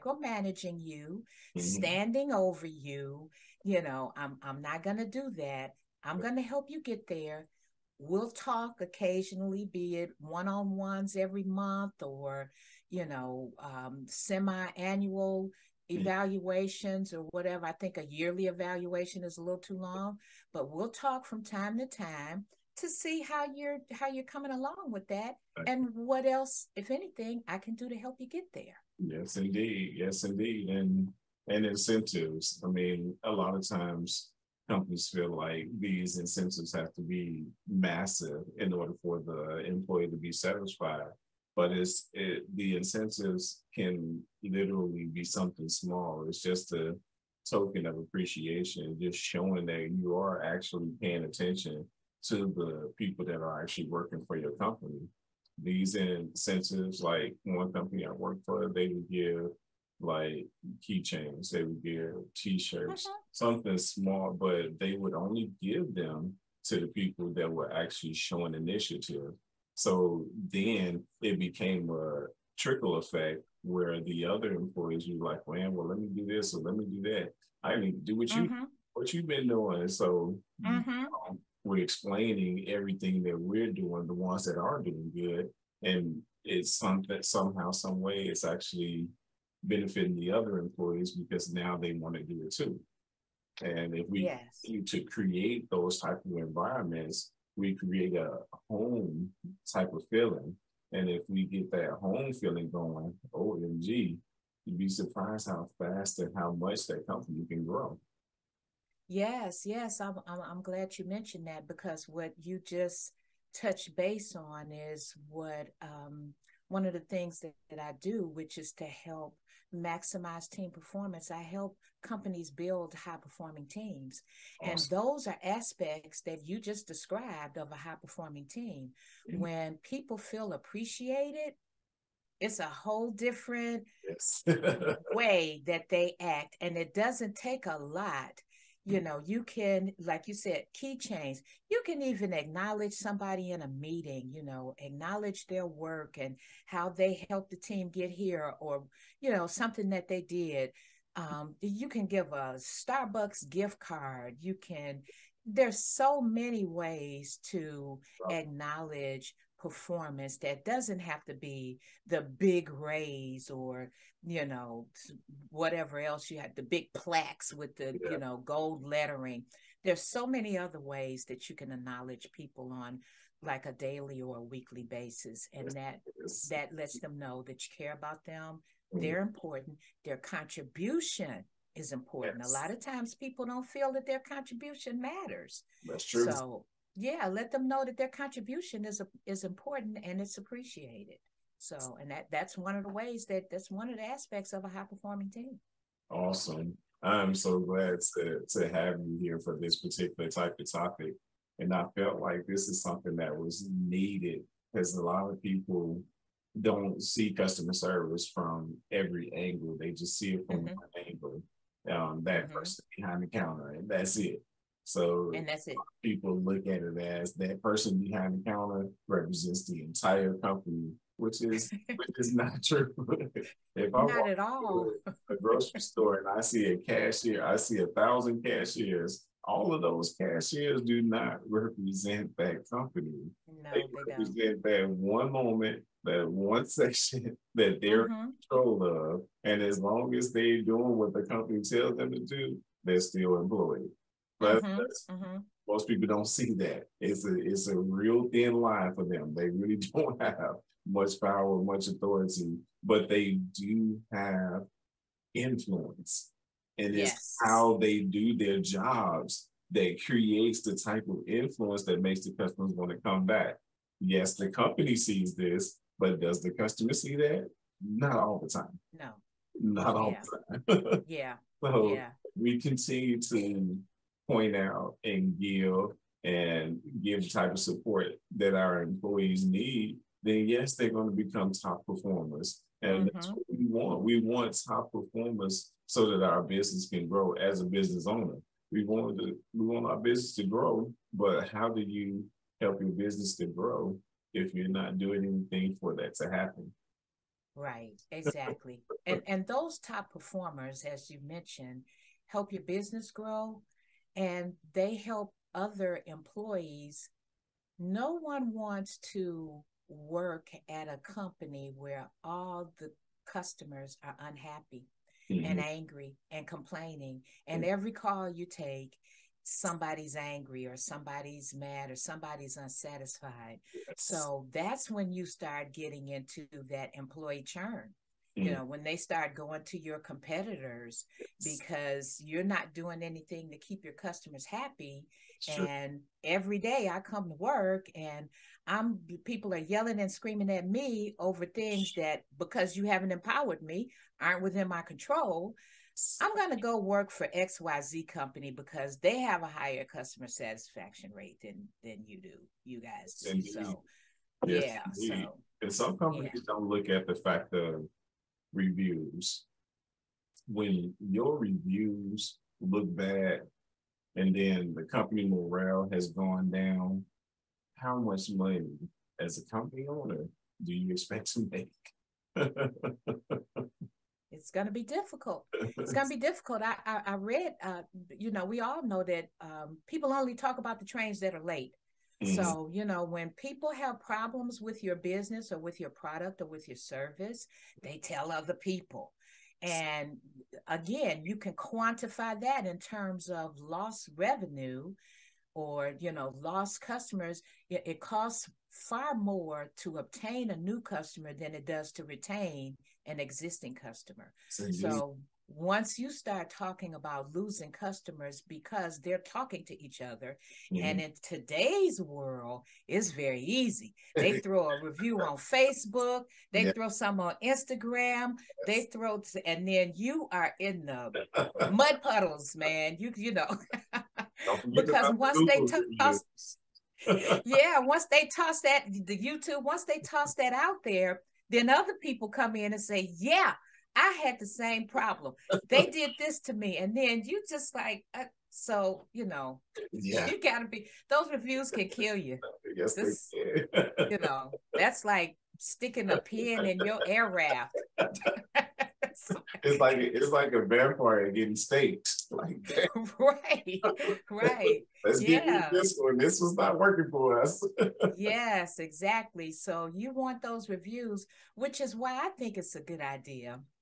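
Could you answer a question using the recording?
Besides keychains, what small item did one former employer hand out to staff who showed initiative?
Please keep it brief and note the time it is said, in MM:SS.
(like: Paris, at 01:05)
t-shirts, at 01:02.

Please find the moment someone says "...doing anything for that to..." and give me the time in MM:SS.
04:54.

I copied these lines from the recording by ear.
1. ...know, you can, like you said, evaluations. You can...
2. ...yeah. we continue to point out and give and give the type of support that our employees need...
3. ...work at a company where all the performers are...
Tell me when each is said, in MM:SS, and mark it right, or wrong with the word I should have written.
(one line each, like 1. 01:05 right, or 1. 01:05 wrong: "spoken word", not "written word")
1. 02:19 wrong: "keychains", not "evaluations"
2. 04:31 right
3. 05:09 wrong: "customers", not "performers".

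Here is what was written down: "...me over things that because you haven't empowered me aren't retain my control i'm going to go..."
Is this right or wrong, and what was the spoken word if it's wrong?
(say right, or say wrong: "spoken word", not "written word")
wrong: "within", not "retain".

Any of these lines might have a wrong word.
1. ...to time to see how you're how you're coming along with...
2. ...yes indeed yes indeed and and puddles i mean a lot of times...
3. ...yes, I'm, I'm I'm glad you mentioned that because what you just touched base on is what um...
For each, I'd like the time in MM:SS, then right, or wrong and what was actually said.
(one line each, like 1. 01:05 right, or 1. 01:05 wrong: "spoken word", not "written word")
1. 00:21 right
2. 00:28 wrong: "incentives", not "puddles"
3. 01:49 right.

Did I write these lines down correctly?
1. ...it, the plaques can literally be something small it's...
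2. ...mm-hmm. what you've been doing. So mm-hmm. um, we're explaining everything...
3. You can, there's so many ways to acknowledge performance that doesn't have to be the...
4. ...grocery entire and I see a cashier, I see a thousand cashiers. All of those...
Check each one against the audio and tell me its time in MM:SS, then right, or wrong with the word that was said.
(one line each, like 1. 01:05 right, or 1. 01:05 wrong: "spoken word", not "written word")
1. 00:42 wrong: "incentives", not "plaques"
2. 01:18 right
3. 02:34 right
4. 03:45 wrong: "store", not "entire".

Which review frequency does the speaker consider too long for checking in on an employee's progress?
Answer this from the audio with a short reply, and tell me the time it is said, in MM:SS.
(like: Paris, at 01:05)
yearly evaluation, at 00:18.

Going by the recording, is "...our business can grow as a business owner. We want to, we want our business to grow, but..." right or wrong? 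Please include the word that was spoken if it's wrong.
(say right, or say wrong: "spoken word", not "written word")
right.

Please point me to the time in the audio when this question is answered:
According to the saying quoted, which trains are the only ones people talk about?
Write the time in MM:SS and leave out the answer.
06:20.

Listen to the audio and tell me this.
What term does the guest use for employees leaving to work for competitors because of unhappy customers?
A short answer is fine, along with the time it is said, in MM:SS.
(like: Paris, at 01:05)
employee churn, at 05:26.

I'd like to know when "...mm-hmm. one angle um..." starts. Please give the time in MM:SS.
03:30.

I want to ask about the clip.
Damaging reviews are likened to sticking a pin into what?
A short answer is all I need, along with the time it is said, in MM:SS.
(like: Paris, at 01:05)
air raft, at 07:27.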